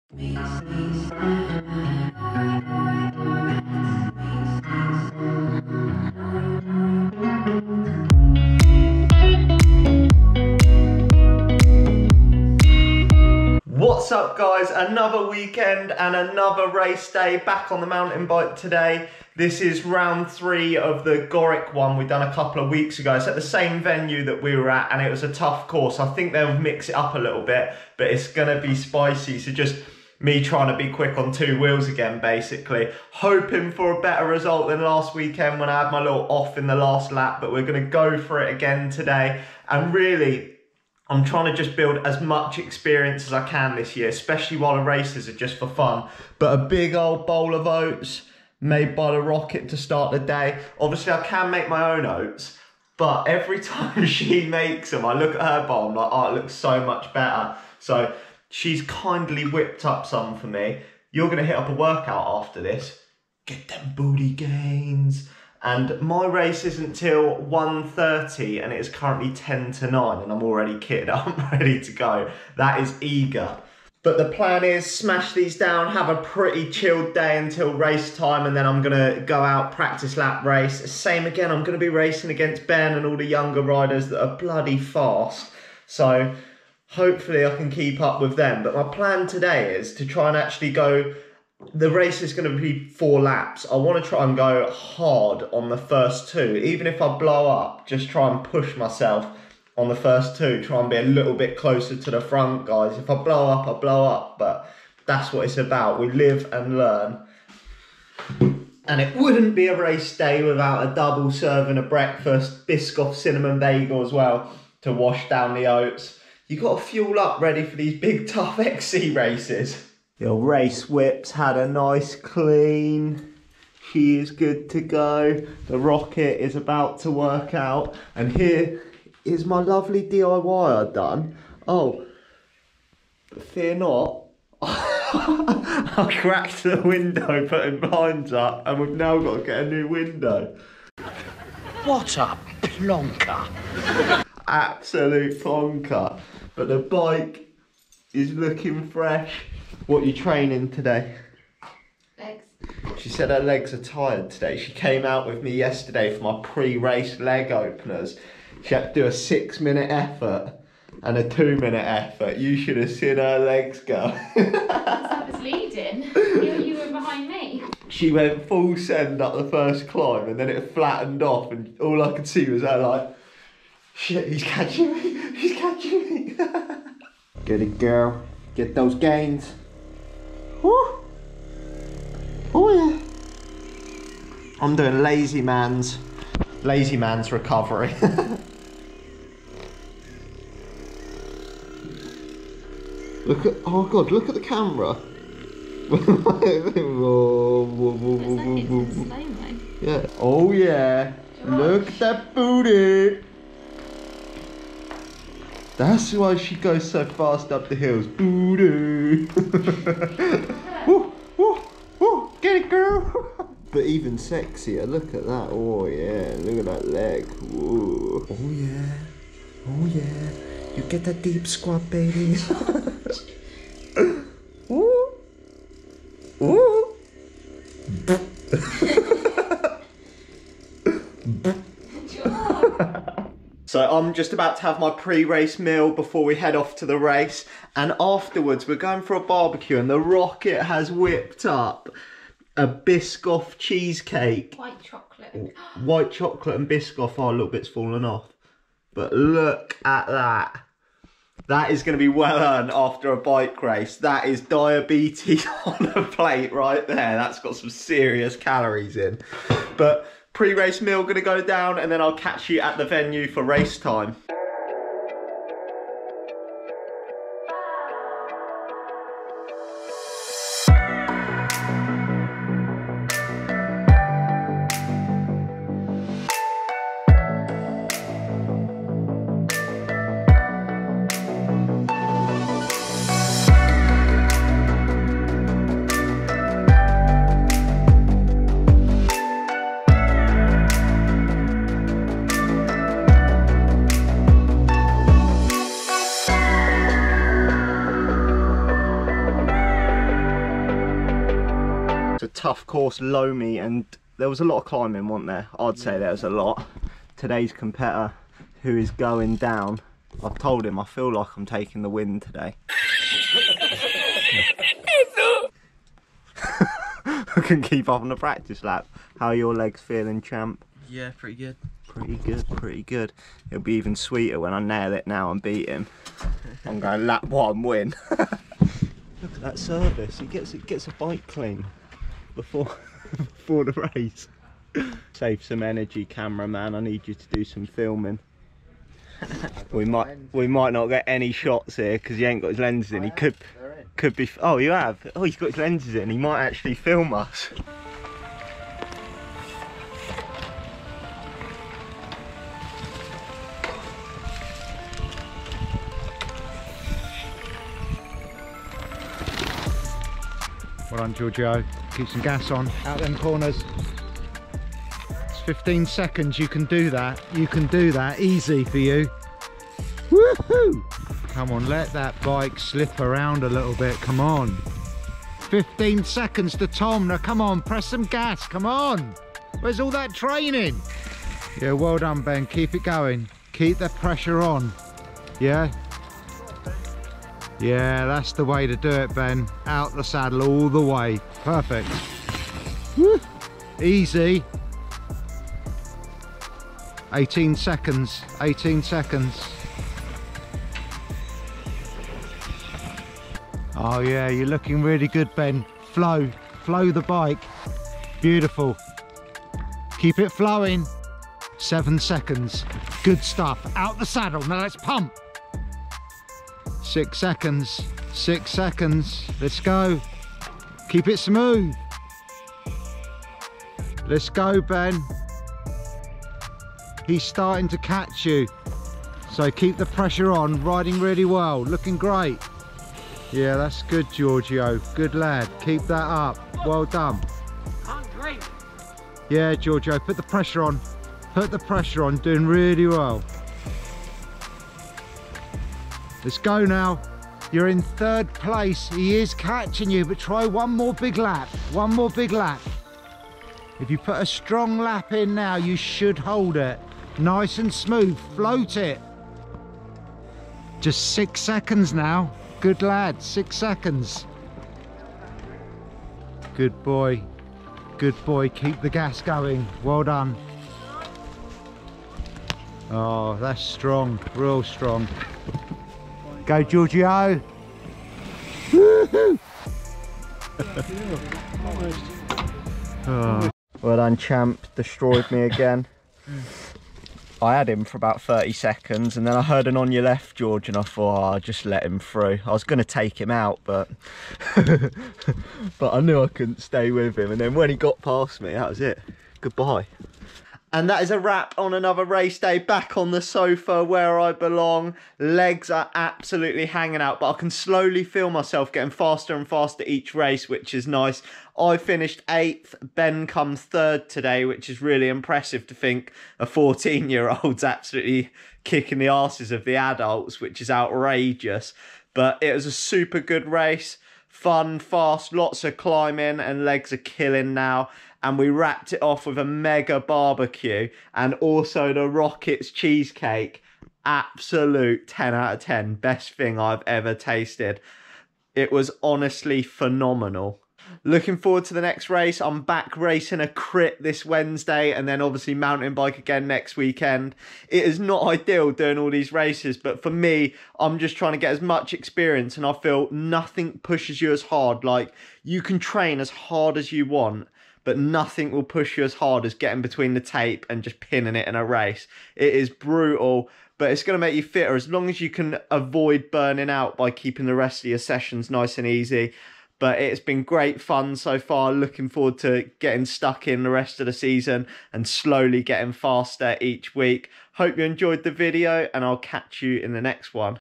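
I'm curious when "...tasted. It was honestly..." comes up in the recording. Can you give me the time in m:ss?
8:57.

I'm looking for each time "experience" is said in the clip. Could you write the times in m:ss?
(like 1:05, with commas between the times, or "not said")
0:42, 9:11.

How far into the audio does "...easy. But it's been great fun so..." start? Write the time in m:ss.
9:28.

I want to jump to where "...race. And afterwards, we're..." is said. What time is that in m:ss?
3:56.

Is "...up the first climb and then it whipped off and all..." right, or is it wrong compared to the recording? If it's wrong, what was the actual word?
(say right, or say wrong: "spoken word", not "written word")
wrong: "flattened", not "whipped".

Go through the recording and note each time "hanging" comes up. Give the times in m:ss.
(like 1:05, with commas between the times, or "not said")
8:26.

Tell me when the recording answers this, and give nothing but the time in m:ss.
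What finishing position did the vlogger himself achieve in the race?
8:32.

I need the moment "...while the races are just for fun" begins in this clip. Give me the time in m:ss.
0:44.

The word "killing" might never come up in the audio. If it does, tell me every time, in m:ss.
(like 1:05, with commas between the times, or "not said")
8:46.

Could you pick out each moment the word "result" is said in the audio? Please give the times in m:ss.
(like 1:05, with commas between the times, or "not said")
0:34.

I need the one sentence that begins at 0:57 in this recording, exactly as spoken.
So She's kindly whipped up some for me.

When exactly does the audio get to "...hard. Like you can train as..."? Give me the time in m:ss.
9:14.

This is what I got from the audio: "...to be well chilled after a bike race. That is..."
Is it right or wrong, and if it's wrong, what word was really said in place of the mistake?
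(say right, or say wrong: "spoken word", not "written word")
wrong: "earned", not "chilled".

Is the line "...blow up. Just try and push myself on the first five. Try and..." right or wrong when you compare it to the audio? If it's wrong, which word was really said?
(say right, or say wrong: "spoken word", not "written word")
wrong: "two", not "five".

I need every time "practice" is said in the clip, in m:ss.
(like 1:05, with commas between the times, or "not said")
1:19, 5:18.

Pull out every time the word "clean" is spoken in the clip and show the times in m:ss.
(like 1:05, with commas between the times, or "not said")
2:02, 5:31.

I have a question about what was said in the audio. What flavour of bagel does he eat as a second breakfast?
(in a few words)
Biscoff cinnamon.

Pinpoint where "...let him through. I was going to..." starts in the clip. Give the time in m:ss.
8:11.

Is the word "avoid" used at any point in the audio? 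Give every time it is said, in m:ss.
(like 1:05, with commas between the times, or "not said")
9:25.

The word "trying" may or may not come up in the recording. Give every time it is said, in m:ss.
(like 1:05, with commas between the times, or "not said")
0:30, 0:41, 9:11.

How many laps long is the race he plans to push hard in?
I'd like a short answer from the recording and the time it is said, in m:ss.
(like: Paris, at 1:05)
4, at 1:32.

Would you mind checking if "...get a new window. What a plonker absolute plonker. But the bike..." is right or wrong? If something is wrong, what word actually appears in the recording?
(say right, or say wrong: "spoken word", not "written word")
right.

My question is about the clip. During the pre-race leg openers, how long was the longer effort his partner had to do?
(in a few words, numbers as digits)
6 minutes.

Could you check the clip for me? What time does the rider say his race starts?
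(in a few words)
1:30.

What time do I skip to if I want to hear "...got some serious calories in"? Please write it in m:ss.
4:17.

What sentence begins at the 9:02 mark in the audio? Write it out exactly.
I'm back racing a crit this Wednesday and then obviously mountain bike again next weekend.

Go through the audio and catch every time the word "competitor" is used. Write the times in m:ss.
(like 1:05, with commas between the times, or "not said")
5:07.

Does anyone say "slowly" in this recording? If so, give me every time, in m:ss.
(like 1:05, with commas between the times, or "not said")
8:27, 9:35.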